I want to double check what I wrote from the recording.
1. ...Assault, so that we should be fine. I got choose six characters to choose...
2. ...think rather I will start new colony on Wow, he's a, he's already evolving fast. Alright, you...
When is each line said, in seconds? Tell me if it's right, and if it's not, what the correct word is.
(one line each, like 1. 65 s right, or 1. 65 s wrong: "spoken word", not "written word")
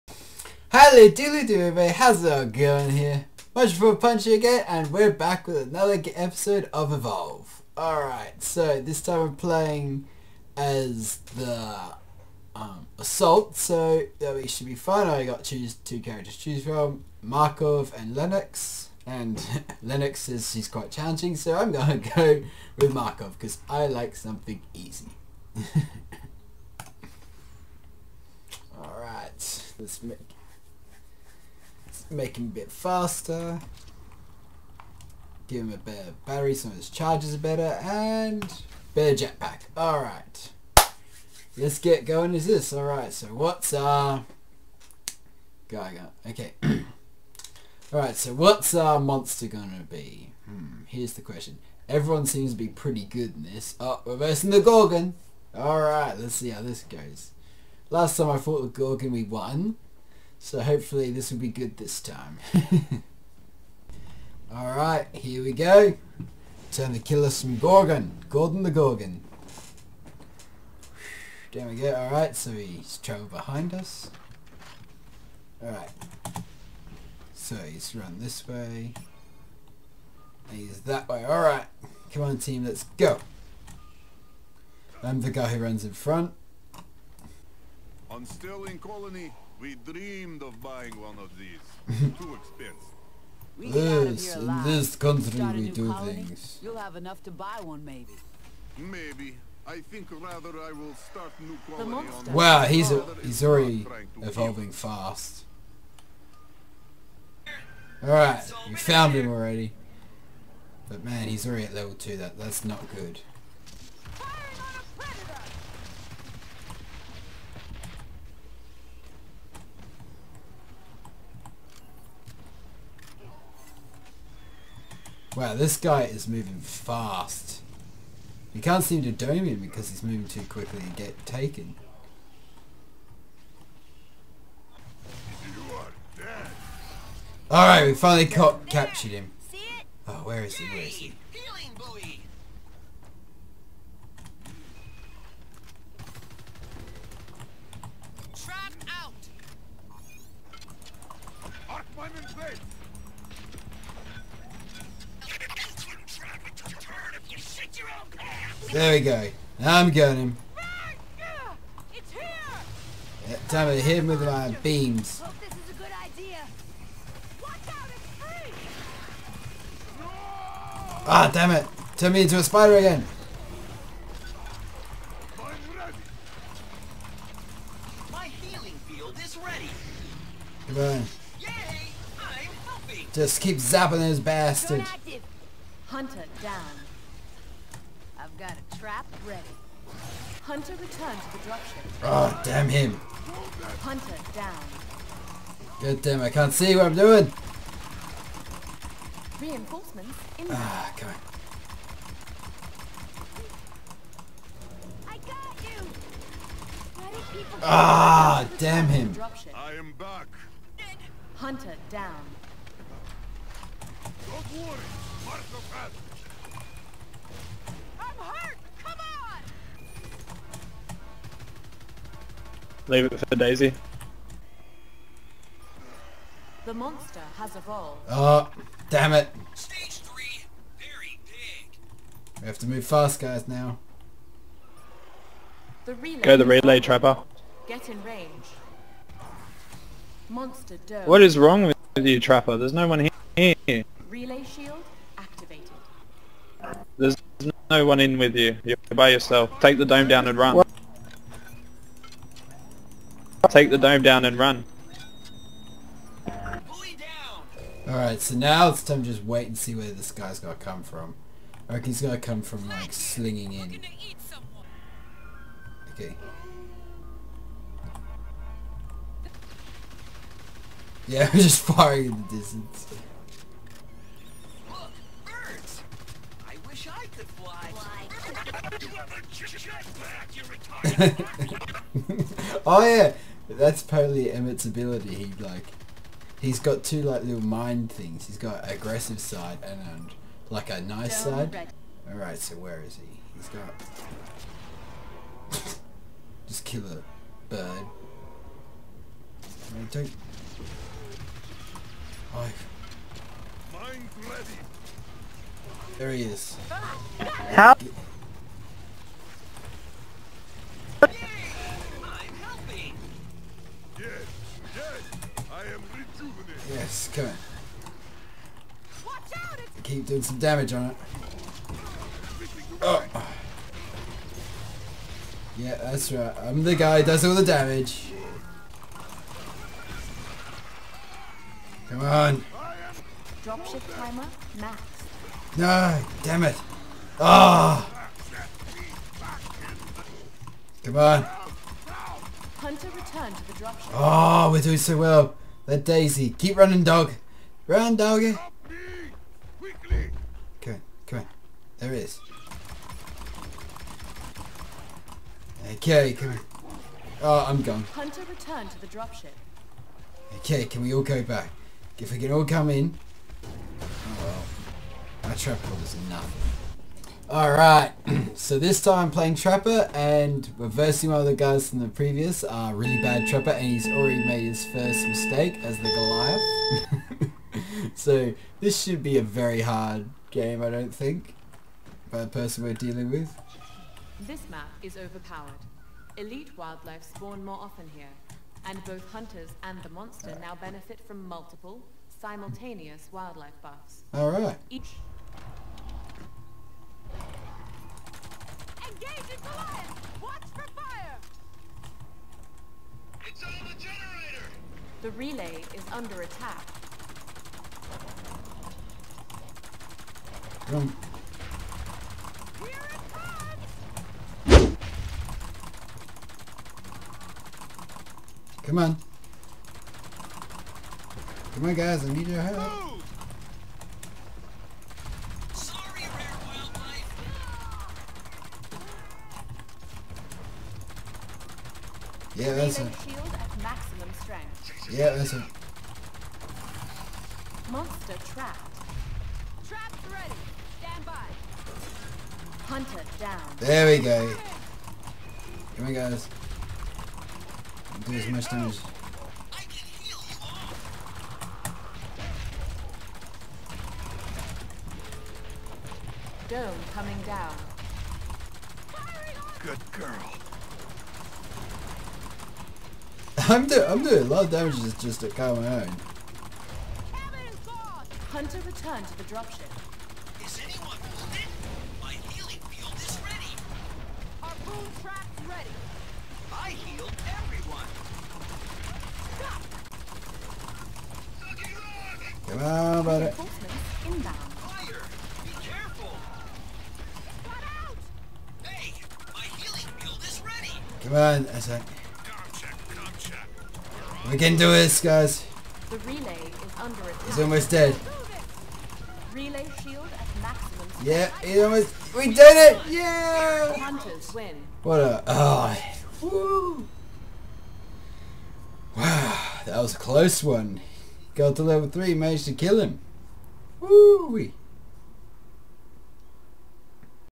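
1. 12 s wrong: "two", not "six"
2. 99 s right.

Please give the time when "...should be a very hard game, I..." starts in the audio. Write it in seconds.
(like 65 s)
378 s.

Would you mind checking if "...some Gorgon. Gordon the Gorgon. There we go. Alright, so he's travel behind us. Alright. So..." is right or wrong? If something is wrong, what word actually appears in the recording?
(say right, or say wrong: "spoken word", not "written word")
right.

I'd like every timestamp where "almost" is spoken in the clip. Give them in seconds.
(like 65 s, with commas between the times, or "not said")
497 s, 501 s.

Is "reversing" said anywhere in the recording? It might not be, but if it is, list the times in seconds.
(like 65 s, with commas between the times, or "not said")
54 s, 370 s.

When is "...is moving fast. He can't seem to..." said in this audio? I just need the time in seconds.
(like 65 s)
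126 s.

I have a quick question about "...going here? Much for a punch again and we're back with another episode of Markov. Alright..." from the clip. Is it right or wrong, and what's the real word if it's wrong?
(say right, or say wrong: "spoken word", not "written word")
wrong: "Evolve", not "Markov".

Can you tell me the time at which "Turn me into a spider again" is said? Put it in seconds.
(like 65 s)
171 s.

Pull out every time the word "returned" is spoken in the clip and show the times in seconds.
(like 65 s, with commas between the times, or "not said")
190 s, 342 s, 358 s, 468 s.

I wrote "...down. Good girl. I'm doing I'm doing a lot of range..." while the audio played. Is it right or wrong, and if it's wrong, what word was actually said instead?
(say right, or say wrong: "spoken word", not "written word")
wrong: "damage", not "range".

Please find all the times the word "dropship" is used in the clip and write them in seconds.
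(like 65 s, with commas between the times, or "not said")
191 s, 333 s, 343 s, 358 s, 469 s.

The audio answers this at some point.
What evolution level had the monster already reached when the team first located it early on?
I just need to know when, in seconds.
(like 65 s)
111 s.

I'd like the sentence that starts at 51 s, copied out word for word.
Everyone seems to be pretty good in this.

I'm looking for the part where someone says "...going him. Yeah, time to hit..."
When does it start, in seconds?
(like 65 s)
159 s.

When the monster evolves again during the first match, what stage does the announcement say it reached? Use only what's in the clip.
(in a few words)
Stage three.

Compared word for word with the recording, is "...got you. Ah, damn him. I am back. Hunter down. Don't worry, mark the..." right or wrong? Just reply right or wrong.
right.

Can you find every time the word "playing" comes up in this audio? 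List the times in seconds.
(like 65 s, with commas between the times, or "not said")
9 s, 369 s.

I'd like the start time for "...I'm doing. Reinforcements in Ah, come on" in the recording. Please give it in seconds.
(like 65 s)
196 s.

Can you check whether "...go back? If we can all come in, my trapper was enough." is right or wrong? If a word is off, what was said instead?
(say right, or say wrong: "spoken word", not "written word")
right.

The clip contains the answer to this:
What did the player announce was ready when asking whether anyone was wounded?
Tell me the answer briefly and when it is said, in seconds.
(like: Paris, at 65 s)
healing field, at 472 s.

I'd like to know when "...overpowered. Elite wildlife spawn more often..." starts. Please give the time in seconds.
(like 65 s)
384 s.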